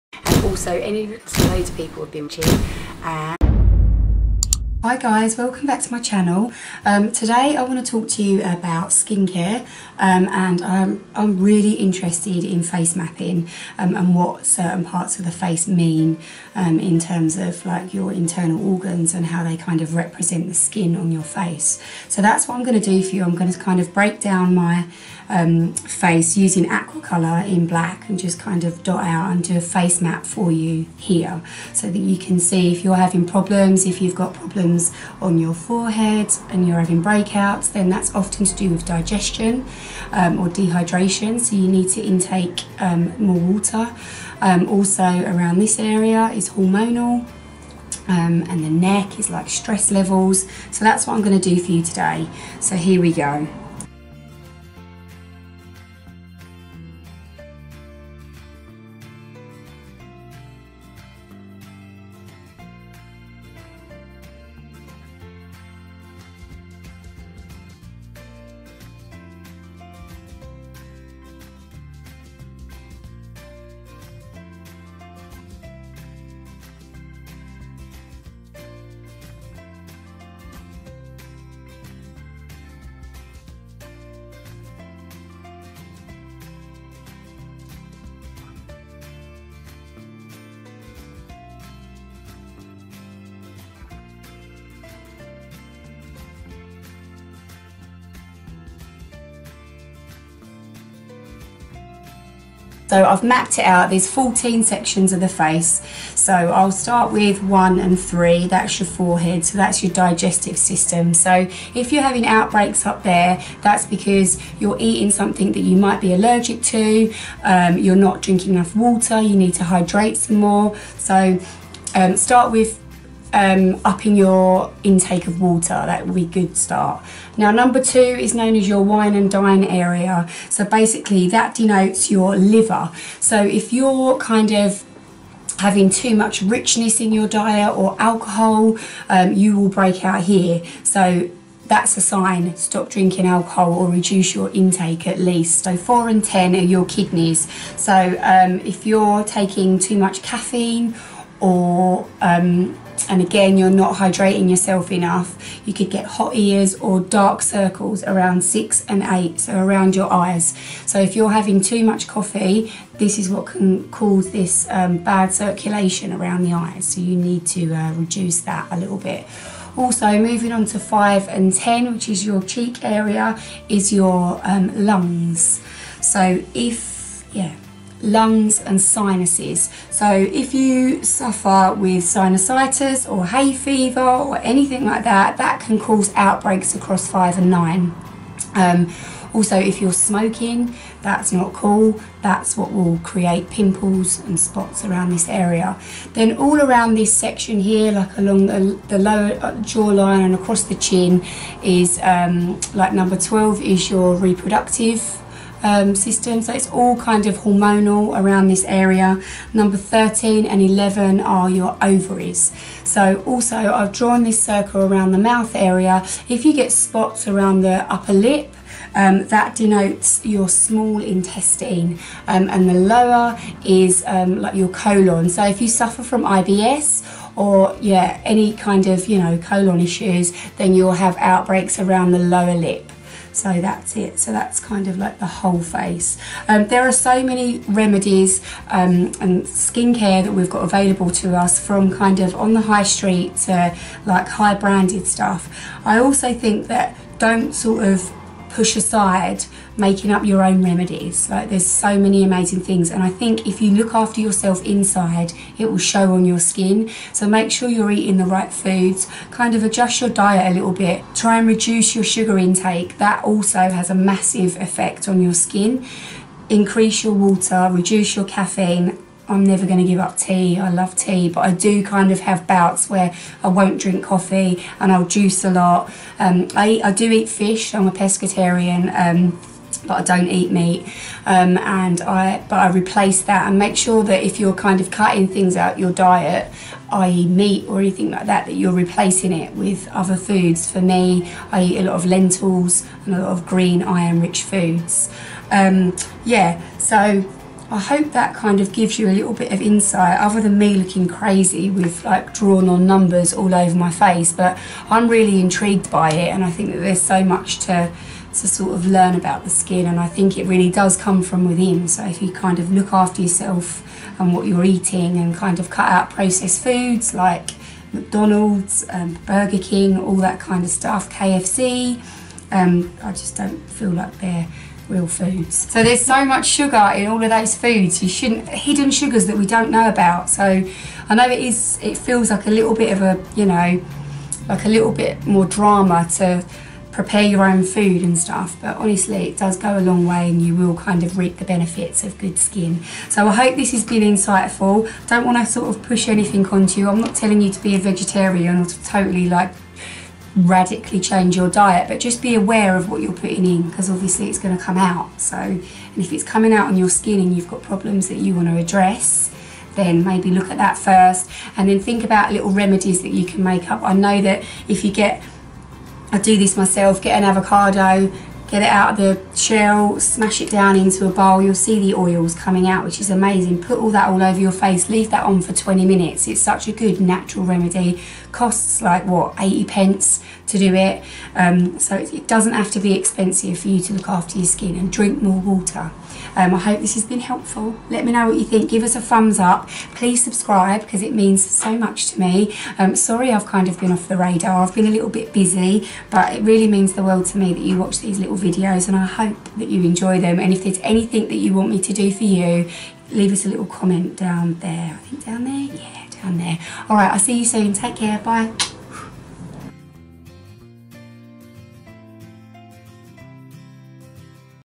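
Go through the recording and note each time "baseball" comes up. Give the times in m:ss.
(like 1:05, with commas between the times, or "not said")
not said.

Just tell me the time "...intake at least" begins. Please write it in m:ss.
2:24.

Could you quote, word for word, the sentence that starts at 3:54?
So that's kind of like the whole face.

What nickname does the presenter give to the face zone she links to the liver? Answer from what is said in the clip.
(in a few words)
wine and dine area.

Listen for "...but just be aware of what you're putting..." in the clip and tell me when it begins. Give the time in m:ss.
5:51.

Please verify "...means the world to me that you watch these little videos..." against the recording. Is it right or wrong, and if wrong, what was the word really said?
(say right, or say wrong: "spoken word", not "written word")
right.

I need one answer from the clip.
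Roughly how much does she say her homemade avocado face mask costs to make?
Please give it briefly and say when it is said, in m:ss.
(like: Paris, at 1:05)
80 pence, at 6:19.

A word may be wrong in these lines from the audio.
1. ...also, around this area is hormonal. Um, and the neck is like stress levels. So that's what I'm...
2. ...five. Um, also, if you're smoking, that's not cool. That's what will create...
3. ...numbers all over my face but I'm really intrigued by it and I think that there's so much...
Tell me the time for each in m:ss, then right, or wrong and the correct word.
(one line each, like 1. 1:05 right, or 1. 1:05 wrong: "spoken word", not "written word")
1. 0:44 right
2. 3:07 wrong: "nine", not "five"
3. 5:02 right.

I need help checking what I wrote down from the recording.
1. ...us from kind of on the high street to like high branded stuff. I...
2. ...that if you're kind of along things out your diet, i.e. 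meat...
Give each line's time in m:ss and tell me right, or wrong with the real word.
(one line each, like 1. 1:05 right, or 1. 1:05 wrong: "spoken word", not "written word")
1. 4:01 right
2. 4:44 wrong: "cutting", not "along".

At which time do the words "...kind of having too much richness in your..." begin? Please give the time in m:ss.
2:14.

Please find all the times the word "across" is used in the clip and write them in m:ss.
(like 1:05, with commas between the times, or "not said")
3:06, 3:20.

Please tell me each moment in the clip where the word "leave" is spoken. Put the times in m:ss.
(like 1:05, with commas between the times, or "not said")
6:14, 6:43.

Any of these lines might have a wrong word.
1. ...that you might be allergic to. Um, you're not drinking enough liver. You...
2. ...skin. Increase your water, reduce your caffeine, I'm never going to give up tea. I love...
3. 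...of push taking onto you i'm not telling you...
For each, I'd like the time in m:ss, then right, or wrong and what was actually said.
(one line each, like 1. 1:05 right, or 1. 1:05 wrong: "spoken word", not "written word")
1. 1:55 wrong: "water", not "liver"
2. 4:25 right
3. 5:45 wrong: "anything", not "taking".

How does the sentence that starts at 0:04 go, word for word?
Hi guys, welcome back to my channel.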